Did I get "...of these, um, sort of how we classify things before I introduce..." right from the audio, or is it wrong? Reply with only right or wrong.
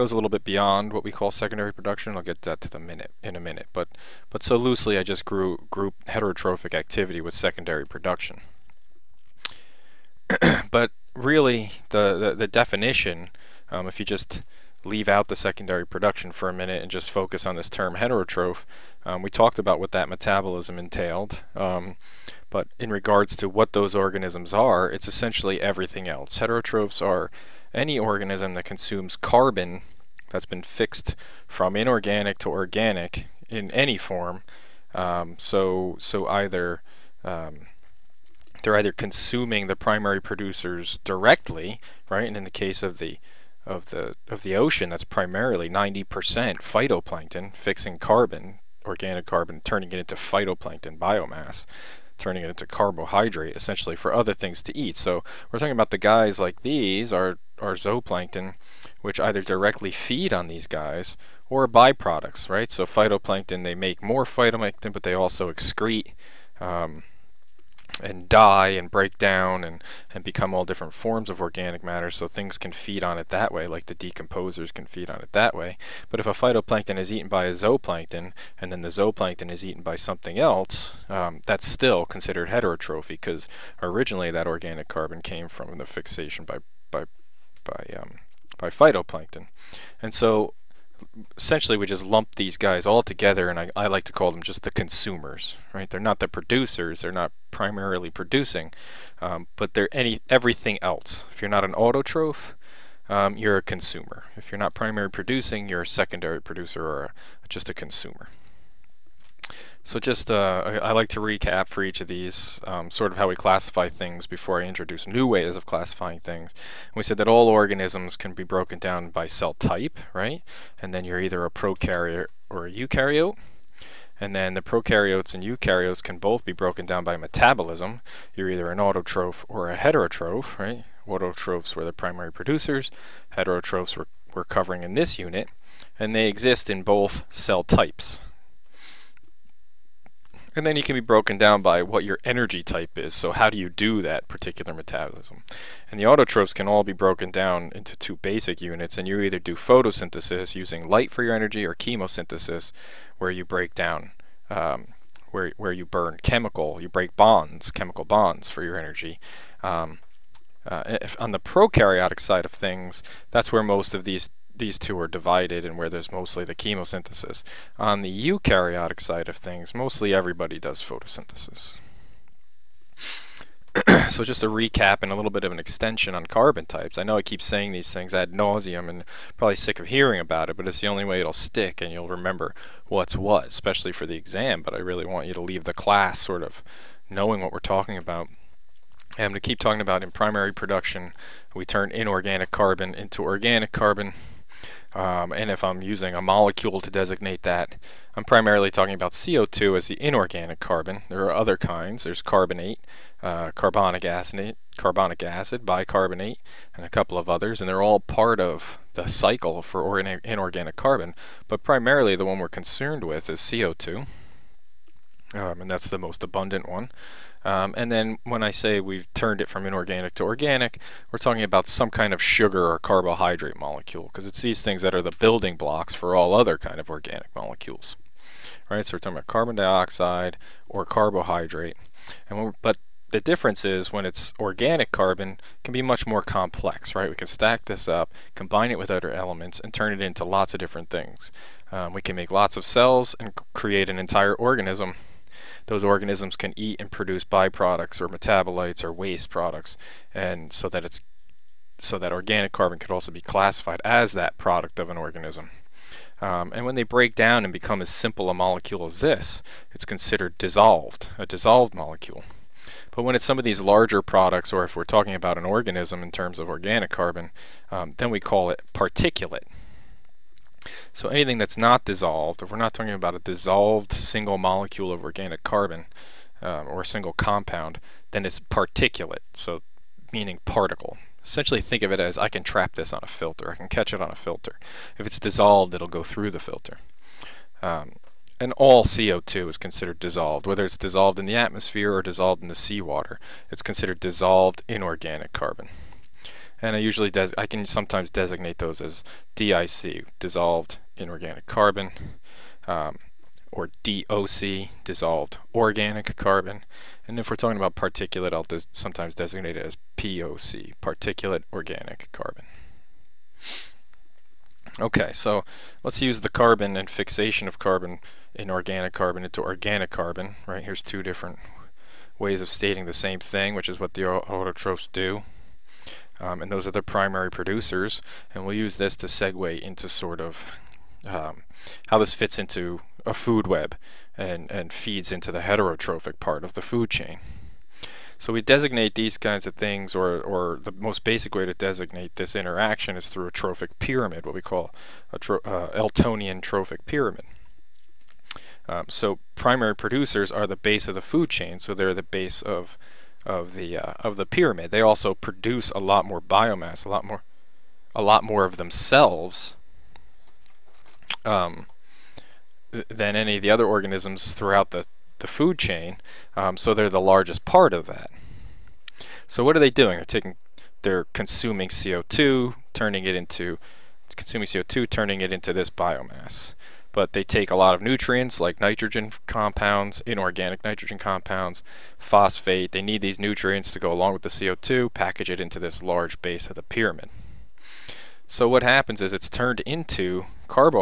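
right.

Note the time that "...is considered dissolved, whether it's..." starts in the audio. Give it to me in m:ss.
4:49.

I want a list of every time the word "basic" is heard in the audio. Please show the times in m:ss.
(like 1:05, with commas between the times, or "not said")
2:28, 5:41.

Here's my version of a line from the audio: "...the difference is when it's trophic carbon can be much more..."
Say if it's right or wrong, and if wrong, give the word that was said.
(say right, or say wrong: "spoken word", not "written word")
wrong: "organic", not "trophic".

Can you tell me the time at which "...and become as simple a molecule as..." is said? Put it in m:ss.
4:17.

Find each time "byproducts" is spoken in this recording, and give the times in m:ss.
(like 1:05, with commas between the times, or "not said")
1:01, 4:07.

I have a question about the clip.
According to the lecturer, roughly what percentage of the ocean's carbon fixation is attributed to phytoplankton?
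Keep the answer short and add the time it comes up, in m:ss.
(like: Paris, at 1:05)
90%, at 0:45.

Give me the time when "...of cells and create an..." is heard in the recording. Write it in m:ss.
4:02.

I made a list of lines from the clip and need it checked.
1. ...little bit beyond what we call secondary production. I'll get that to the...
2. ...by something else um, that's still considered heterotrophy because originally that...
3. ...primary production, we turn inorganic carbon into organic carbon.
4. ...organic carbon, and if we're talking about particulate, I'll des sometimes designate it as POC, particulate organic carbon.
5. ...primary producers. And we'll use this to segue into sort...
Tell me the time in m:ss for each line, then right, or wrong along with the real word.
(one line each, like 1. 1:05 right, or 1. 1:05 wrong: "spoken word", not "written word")
1. 0:00 right
2. 1:19 right
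3. 3:10 right
4. 5:05 right
5. 5:26 right.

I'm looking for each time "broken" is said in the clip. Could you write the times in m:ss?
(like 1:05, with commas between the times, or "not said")
1:58, 2:06, 2:20, 2:26.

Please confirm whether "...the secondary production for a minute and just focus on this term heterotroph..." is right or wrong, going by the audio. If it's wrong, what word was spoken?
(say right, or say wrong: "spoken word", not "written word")
right.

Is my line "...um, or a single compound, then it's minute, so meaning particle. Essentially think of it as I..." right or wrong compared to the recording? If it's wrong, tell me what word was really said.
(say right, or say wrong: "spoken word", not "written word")
wrong: "particulate", not "minute".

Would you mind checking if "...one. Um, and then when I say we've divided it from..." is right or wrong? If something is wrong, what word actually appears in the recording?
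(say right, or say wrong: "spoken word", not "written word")
wrong: "turned", not "divided".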